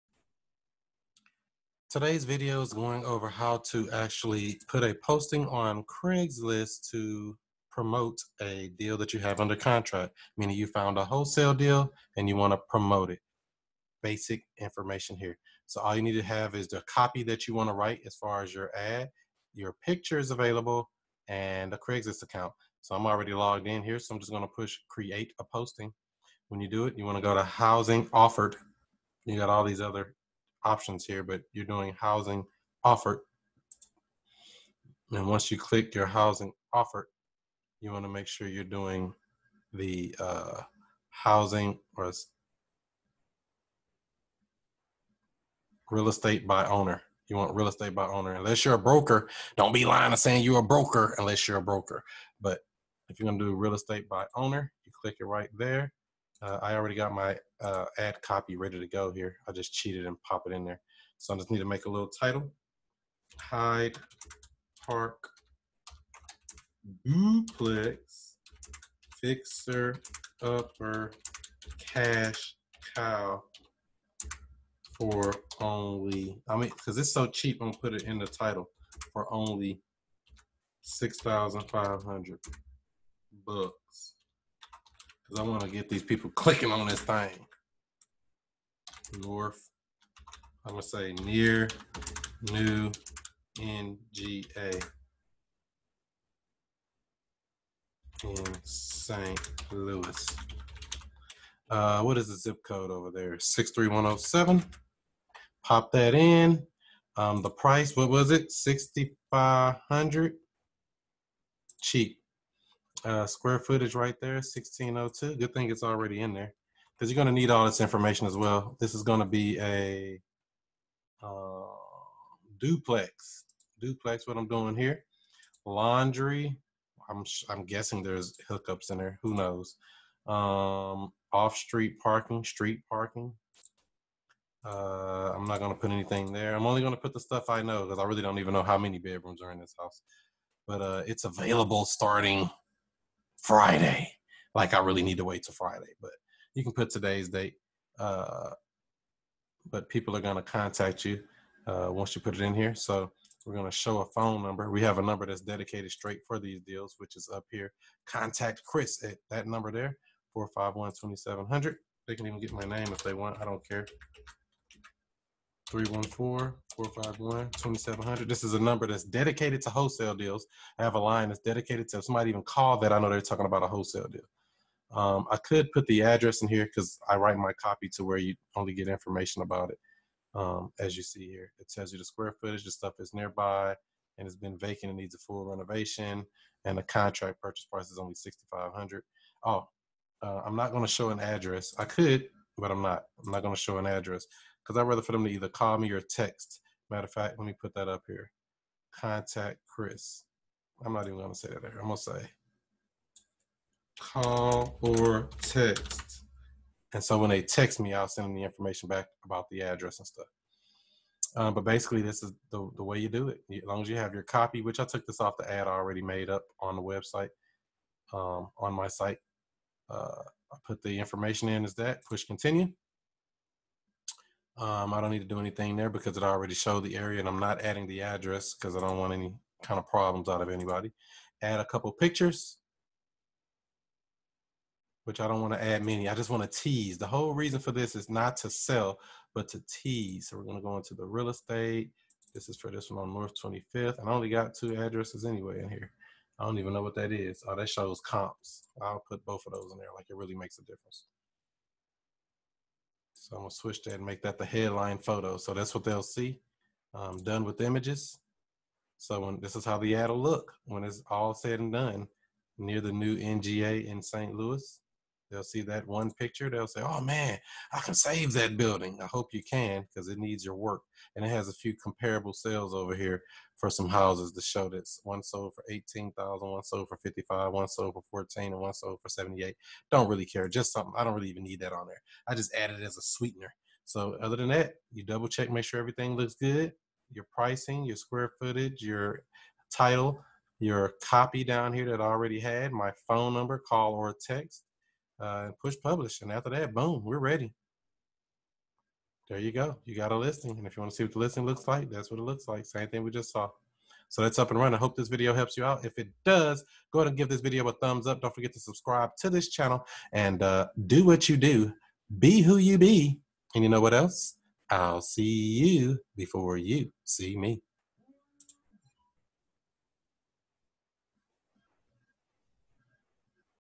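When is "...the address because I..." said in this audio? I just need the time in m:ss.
3:47.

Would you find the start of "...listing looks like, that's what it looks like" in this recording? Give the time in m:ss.
5:01.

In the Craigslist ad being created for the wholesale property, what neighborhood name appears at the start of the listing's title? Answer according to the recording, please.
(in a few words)
Hyde Park.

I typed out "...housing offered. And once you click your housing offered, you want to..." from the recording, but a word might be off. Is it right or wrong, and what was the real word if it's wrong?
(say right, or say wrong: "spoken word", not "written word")
right.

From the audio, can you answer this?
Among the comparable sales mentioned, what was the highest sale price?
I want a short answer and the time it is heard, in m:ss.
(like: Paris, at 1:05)
78,000, at 4:39.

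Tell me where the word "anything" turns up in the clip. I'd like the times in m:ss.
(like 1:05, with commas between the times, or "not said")
2:15, 3:45.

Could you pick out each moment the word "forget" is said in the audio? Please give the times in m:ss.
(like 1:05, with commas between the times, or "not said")
5:08.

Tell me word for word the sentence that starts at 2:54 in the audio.
Um, I could put the address in here because I write my copy to where you only get information about it.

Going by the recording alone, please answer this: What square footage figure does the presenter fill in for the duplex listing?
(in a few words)
1602.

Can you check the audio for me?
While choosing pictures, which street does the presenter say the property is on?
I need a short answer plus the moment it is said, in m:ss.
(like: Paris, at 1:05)
North 25th, at 4:03.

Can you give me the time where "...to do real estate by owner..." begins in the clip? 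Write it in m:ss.
0:53.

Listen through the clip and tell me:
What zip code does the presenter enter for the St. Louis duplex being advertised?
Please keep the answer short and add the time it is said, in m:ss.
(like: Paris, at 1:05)
63107, at 1:43.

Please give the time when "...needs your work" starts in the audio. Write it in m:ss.
4:30.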